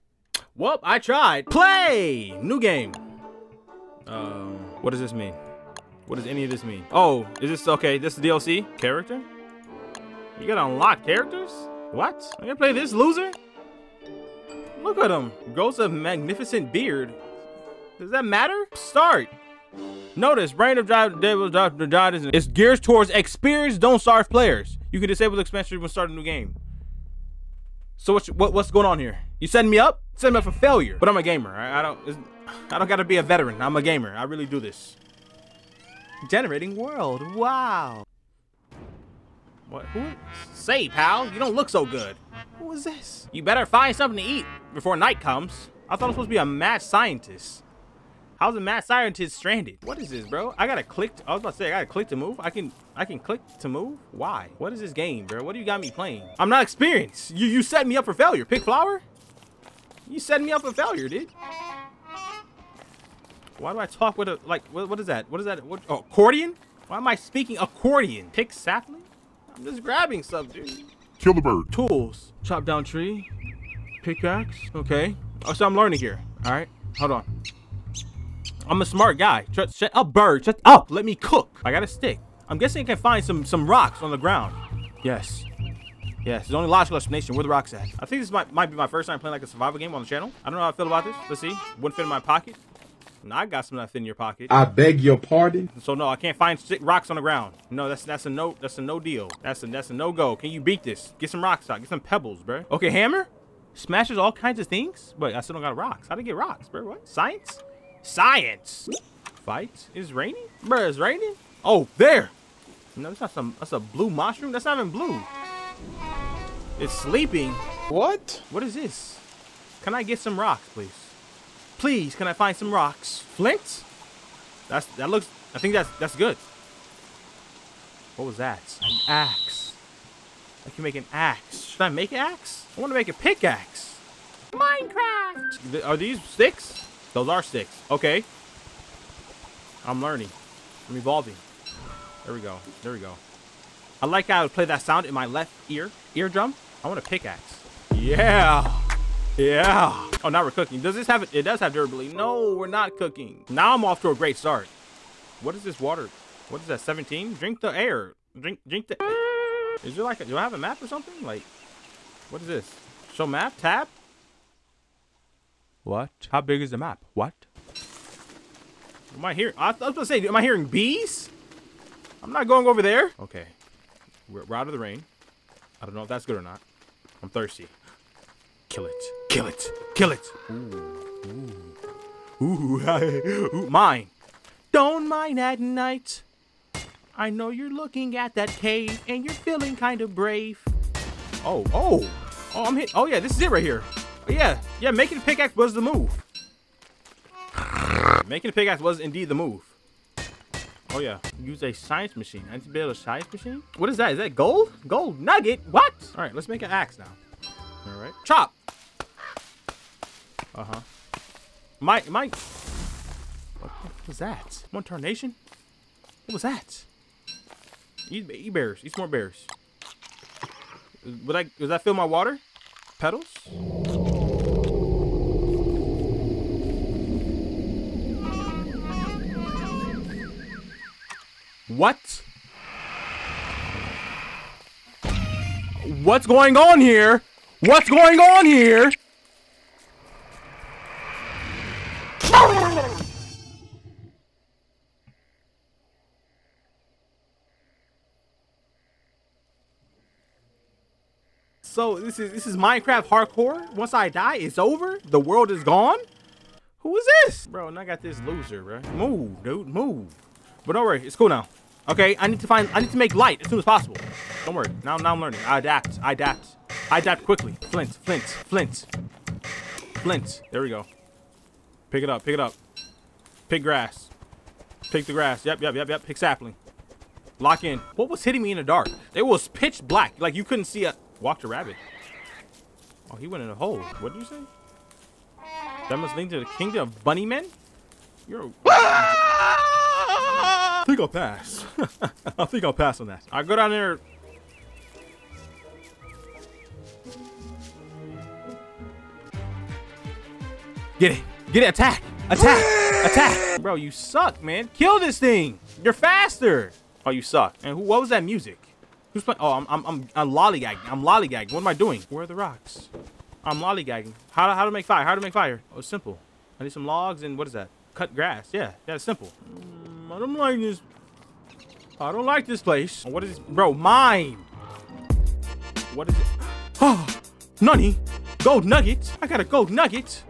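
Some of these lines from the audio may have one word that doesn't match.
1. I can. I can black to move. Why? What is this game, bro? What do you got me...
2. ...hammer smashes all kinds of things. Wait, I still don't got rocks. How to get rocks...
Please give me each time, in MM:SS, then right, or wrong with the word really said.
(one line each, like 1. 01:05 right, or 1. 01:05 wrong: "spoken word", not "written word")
1. 00:52 wrong: "click", not "black"
2. 01:42 right.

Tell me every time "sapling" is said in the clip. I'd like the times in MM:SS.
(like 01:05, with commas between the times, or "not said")
01:08, 04:36.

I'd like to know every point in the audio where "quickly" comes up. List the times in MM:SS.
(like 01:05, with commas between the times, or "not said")
04:27.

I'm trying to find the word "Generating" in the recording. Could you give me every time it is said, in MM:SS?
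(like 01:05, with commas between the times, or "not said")
00:36.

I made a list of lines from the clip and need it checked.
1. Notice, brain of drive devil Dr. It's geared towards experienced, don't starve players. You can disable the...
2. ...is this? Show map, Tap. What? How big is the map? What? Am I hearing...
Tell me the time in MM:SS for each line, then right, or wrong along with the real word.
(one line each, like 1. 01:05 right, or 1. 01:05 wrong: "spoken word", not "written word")
1. 00:20 right
2. 02:42 right.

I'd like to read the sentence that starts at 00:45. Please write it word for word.
I thought I was supposed to be a mad scientist.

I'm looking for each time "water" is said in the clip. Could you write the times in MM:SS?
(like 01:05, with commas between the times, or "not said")
02:35, 03:42.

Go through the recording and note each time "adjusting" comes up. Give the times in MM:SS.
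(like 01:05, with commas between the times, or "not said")
not said.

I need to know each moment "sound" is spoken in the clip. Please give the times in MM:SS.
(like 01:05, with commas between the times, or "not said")
02:24.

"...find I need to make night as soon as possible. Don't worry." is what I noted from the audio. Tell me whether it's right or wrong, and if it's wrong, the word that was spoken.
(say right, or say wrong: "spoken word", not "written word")
wrong: "light", not "night".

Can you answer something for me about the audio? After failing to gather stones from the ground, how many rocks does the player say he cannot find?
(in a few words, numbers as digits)
6.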